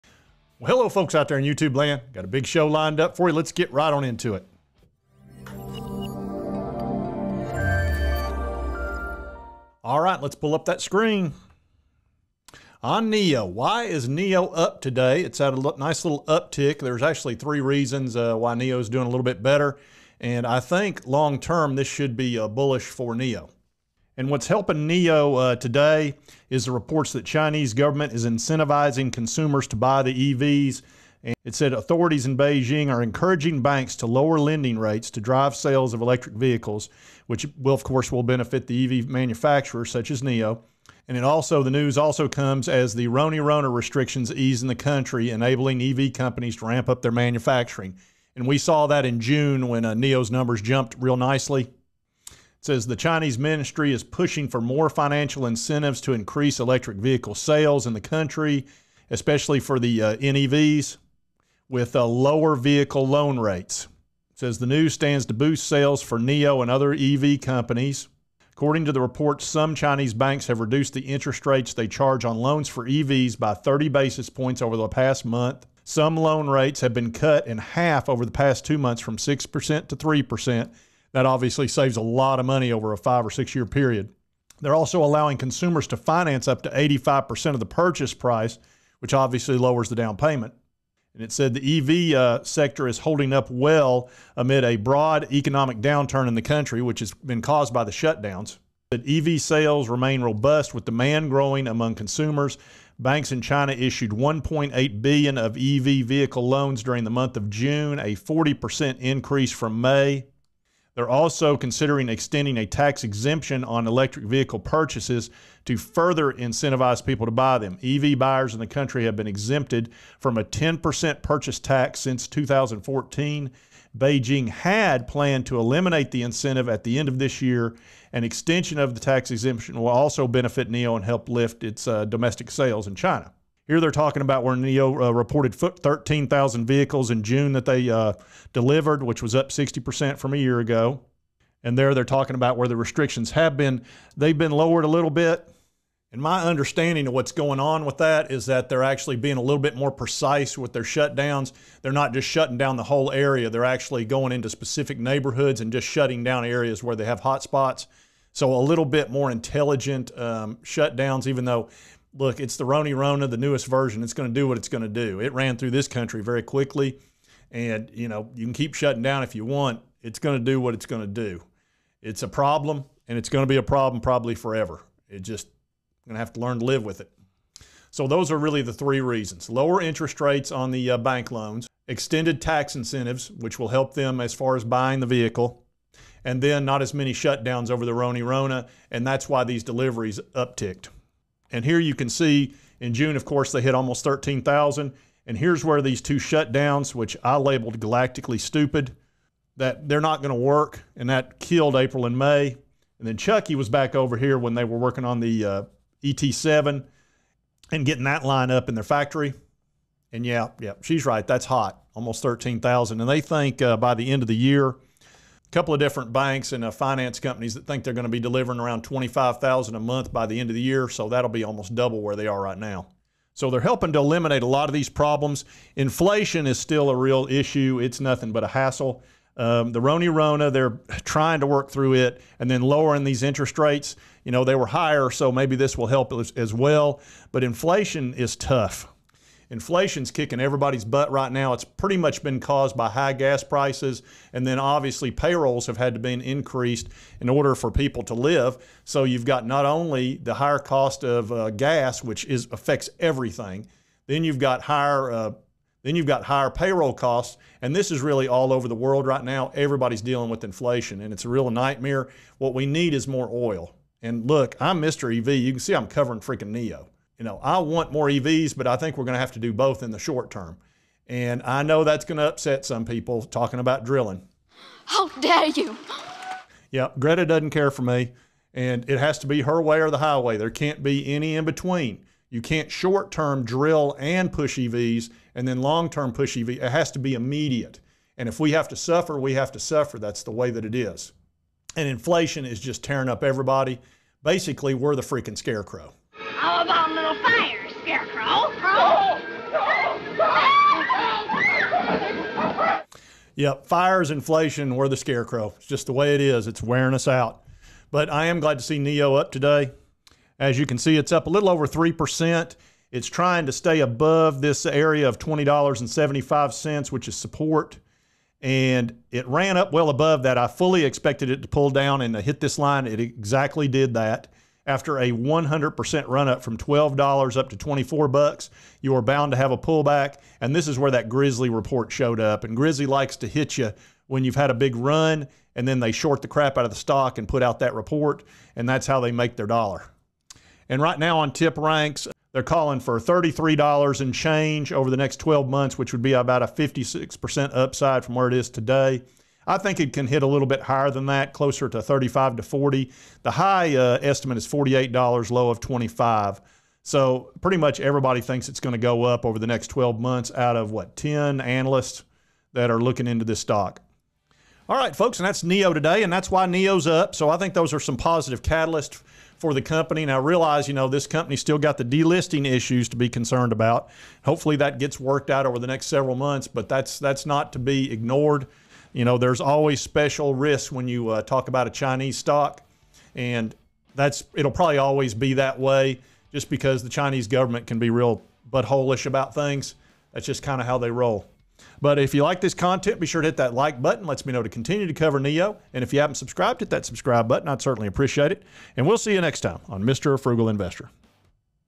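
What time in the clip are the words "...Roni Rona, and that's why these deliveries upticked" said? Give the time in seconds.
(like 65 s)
187 s.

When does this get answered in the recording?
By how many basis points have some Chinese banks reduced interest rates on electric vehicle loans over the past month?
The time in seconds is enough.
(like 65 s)
73 s.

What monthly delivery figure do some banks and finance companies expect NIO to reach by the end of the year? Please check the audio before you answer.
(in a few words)
25,000.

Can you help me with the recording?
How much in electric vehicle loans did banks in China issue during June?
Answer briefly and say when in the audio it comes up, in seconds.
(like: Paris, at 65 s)
1.8 billion, at 104 s.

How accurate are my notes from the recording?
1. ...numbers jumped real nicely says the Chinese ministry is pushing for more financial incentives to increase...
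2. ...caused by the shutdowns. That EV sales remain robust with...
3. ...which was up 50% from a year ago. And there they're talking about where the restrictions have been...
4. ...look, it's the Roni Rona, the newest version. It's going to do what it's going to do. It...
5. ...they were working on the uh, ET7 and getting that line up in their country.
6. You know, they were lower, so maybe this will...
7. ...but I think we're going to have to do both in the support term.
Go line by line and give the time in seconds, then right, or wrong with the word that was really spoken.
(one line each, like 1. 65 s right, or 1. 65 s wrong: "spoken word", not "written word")
1. 50 s right
2. 97 s right
3. 139 s wrong: "60", not "50"
4. 162 s right
5. 204 s wrong: "factory", not "country"
6. 234 s wrong: "higher", not "lower"
7. 268 s wrong: "short", not "support".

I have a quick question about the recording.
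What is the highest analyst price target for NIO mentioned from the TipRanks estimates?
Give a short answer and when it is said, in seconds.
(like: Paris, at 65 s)
$48, at 354 s.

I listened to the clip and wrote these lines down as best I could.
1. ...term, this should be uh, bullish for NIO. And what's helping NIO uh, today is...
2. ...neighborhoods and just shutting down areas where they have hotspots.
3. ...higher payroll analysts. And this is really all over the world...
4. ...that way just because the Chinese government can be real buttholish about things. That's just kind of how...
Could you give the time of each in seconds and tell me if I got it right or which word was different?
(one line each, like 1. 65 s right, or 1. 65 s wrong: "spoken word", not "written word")
1. 21 s right
2. 154 s right
3. 256 s wrong: "costs", not "analysts"
4. 385 s right.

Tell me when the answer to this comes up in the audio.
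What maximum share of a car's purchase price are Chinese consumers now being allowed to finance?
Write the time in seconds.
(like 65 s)
86 s.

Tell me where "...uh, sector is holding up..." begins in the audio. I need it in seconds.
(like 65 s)
92 s.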